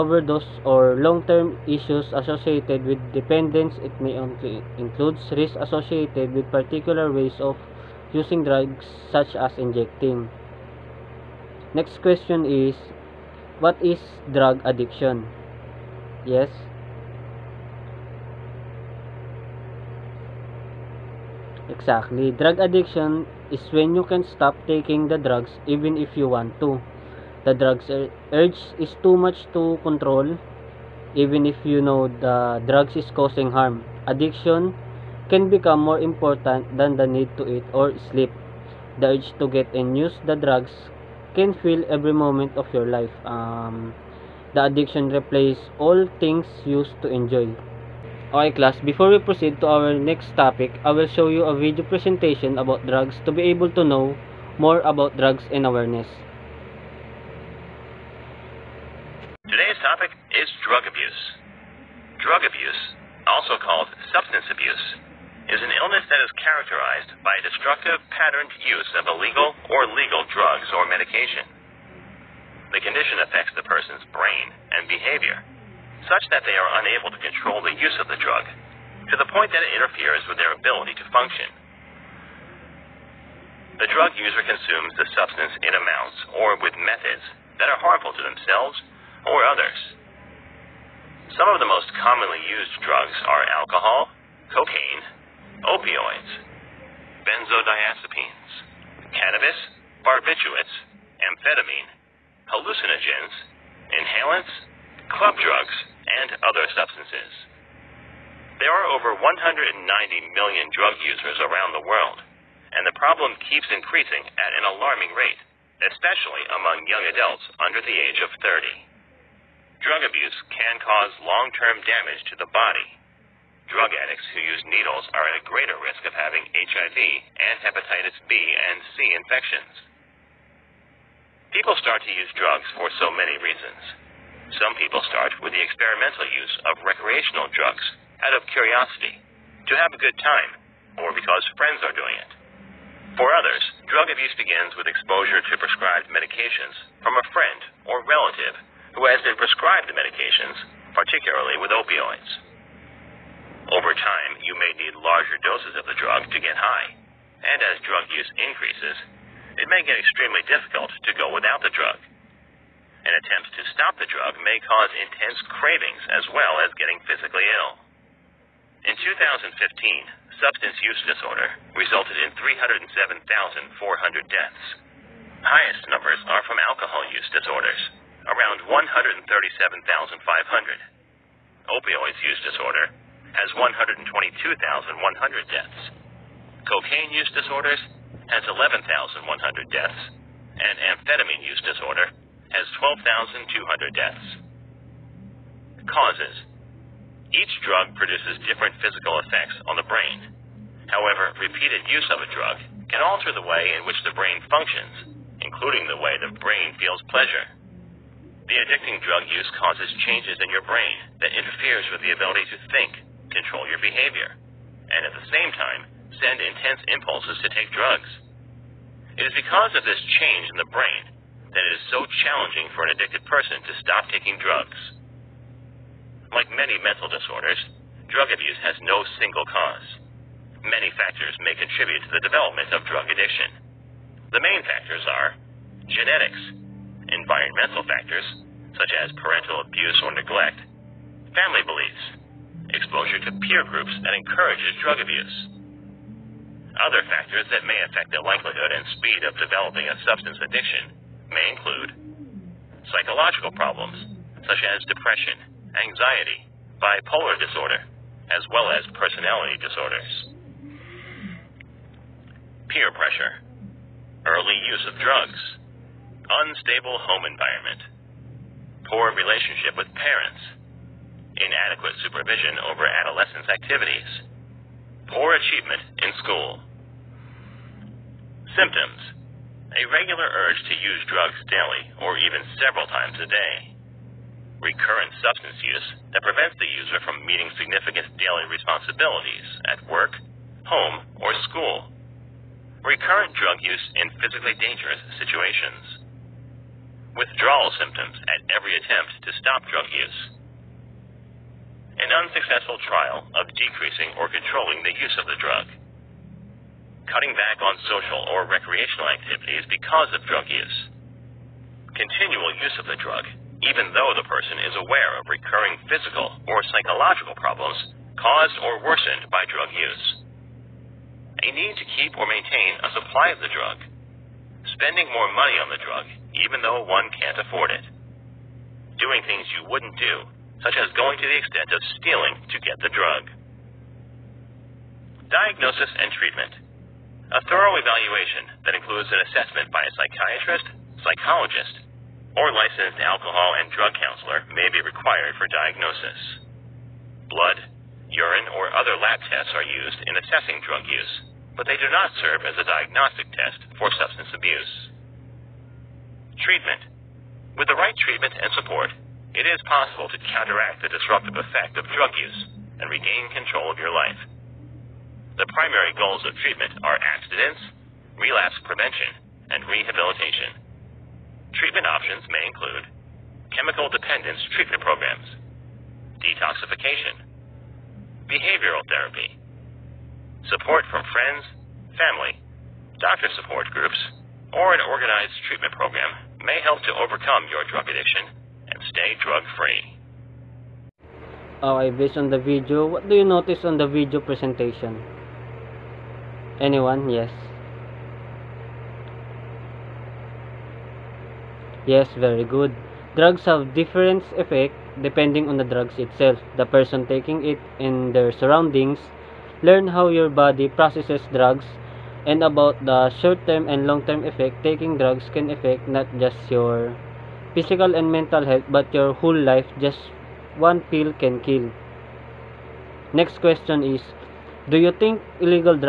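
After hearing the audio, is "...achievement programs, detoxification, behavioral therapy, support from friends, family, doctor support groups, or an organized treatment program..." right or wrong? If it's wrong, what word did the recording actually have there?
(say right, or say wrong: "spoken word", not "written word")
wrong: "treatment", not "achievement".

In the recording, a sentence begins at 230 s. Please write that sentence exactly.
Many factors may contribute to the development of drug addiction.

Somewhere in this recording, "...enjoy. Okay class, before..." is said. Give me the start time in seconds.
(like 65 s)
47 s.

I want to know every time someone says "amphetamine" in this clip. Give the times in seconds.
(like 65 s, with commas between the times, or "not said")
101 s, 190 s.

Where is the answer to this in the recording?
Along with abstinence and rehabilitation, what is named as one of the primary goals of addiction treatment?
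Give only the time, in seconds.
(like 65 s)
368 s.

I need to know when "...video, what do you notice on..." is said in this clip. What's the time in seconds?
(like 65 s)
392 s.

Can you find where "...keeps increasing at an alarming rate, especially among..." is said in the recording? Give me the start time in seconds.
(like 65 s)
113 s.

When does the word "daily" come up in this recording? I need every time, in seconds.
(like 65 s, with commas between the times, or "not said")
281 s, 288 s.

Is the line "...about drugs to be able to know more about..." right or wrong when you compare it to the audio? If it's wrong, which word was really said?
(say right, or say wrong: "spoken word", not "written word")
right.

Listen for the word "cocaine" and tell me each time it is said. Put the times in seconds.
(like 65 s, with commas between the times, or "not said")
94 s, 186 s.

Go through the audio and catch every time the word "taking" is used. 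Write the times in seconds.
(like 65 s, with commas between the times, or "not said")
24 s, 224 s, 407 s, 414 s.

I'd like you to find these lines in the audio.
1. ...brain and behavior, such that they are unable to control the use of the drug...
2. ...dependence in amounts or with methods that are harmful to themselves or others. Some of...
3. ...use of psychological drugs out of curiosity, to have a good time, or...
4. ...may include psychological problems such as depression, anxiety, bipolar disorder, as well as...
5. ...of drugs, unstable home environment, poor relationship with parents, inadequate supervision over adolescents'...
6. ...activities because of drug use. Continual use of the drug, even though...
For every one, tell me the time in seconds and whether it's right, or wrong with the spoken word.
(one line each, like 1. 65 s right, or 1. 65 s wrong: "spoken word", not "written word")
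1. 74 s right
2. 85 s wrong: "substance", not "dependence"
3. 136 s wrong: "recreational", not "psychological"
4. 251 s right
5. 264 s right
6. 309 s right.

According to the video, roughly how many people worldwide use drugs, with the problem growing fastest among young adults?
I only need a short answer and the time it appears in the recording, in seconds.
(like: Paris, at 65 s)
over 190 million, at 108 s.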